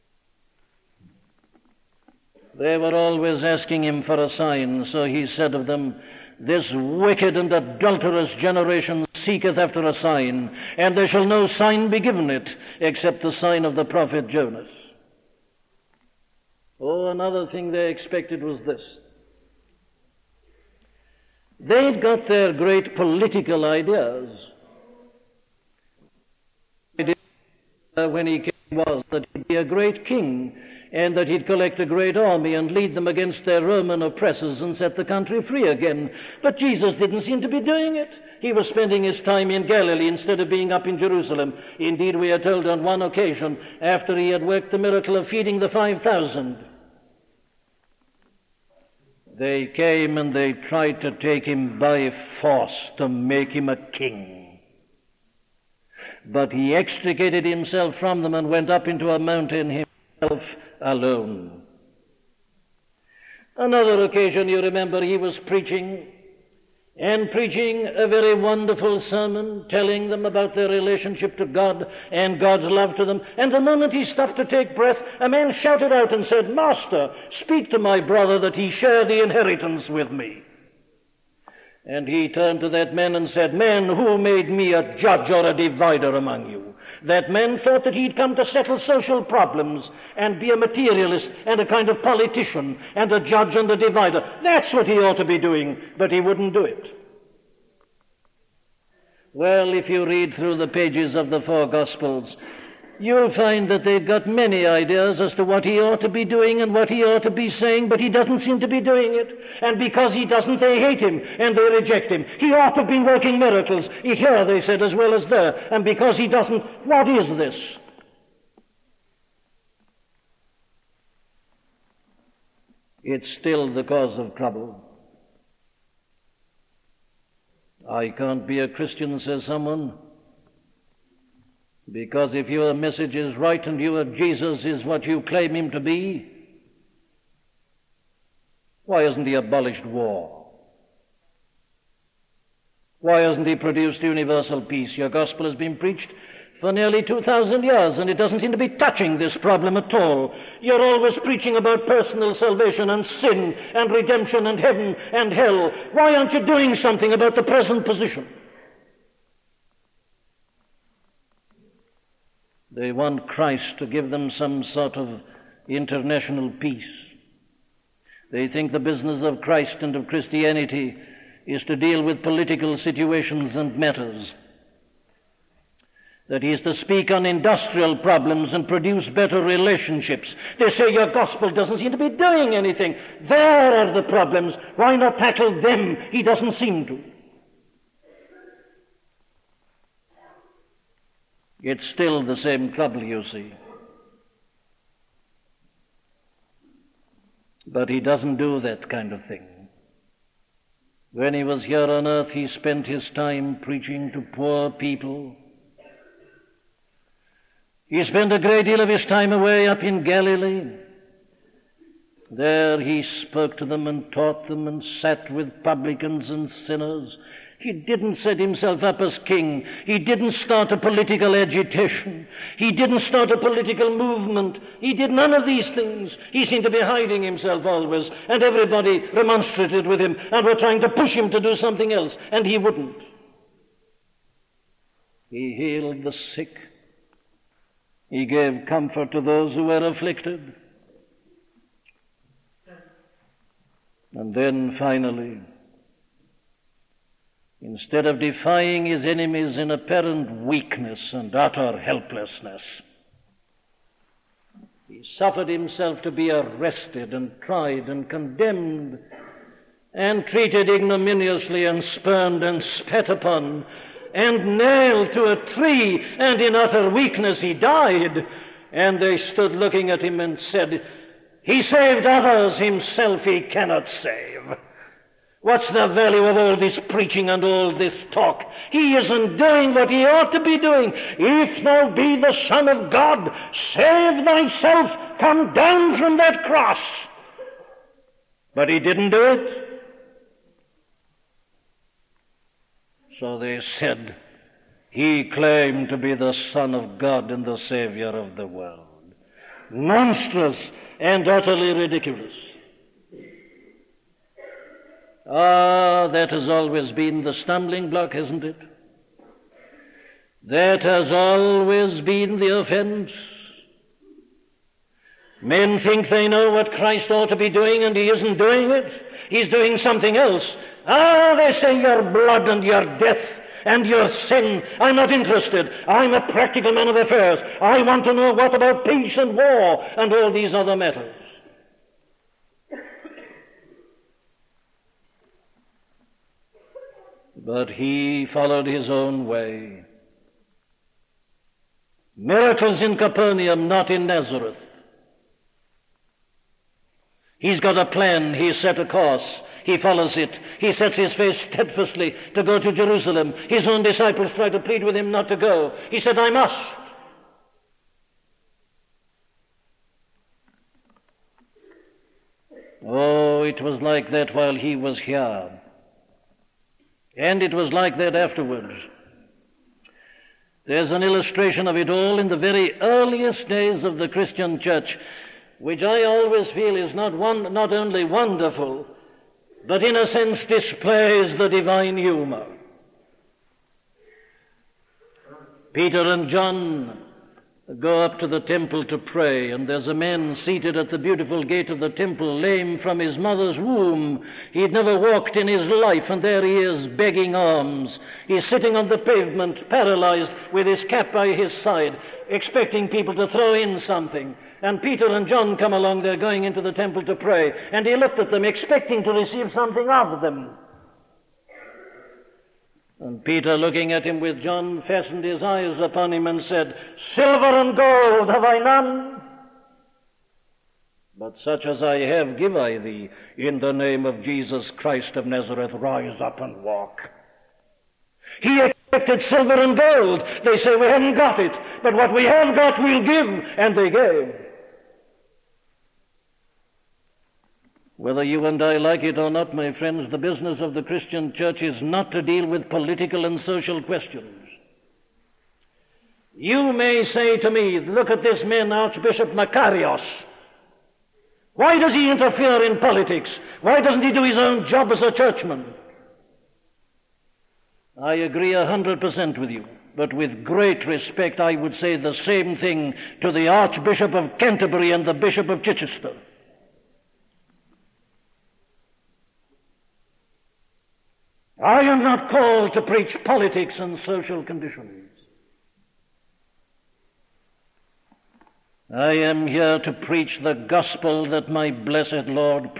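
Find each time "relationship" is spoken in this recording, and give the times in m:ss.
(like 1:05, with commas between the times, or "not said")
1:10, 2:59.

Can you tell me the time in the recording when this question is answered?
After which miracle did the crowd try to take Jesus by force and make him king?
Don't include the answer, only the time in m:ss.
0:45.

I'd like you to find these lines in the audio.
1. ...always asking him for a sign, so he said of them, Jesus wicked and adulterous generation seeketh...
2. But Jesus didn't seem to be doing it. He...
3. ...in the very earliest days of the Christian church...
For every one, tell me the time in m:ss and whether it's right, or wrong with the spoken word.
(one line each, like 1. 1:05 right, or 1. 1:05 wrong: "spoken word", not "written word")
1. 0:02 wrong: "This", not "Jesus"
2. 0:36 right
3. 6:12 right.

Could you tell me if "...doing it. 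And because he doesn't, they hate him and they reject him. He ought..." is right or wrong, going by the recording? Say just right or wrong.
right.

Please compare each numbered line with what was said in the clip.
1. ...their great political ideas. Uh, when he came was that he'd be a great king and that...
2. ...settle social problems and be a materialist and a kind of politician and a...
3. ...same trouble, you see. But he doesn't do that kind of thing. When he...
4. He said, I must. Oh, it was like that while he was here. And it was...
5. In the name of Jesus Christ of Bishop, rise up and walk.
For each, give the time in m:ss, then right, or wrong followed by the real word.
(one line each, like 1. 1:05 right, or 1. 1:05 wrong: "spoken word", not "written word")
1. 0:22 right
2. 1:28 right
3. 3:12 right
4. 5:55 right
5. 7:03 wrong: "Nazareth", not "Bishop".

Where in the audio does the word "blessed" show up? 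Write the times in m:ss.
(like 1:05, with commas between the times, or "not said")
8:01.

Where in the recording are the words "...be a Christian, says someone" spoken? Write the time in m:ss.
2:08.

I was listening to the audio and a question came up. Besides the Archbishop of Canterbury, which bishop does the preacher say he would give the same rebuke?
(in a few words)
Bishop of Chichester.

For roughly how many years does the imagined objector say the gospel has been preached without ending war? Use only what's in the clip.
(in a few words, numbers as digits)
2,000.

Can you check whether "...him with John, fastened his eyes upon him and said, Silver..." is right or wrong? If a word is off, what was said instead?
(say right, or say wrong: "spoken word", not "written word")
right.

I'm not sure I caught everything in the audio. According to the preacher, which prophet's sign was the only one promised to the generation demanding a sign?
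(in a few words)
Jonas.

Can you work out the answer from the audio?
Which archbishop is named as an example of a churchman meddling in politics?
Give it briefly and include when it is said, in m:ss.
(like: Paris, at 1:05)
Archbishop Makarios, at 7:29.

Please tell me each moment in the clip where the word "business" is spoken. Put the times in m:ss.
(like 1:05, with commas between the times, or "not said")
2:48, 7:20.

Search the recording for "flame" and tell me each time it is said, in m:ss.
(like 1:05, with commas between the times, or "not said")
not said.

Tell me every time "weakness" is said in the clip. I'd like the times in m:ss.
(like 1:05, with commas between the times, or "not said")
4:10, 4:26.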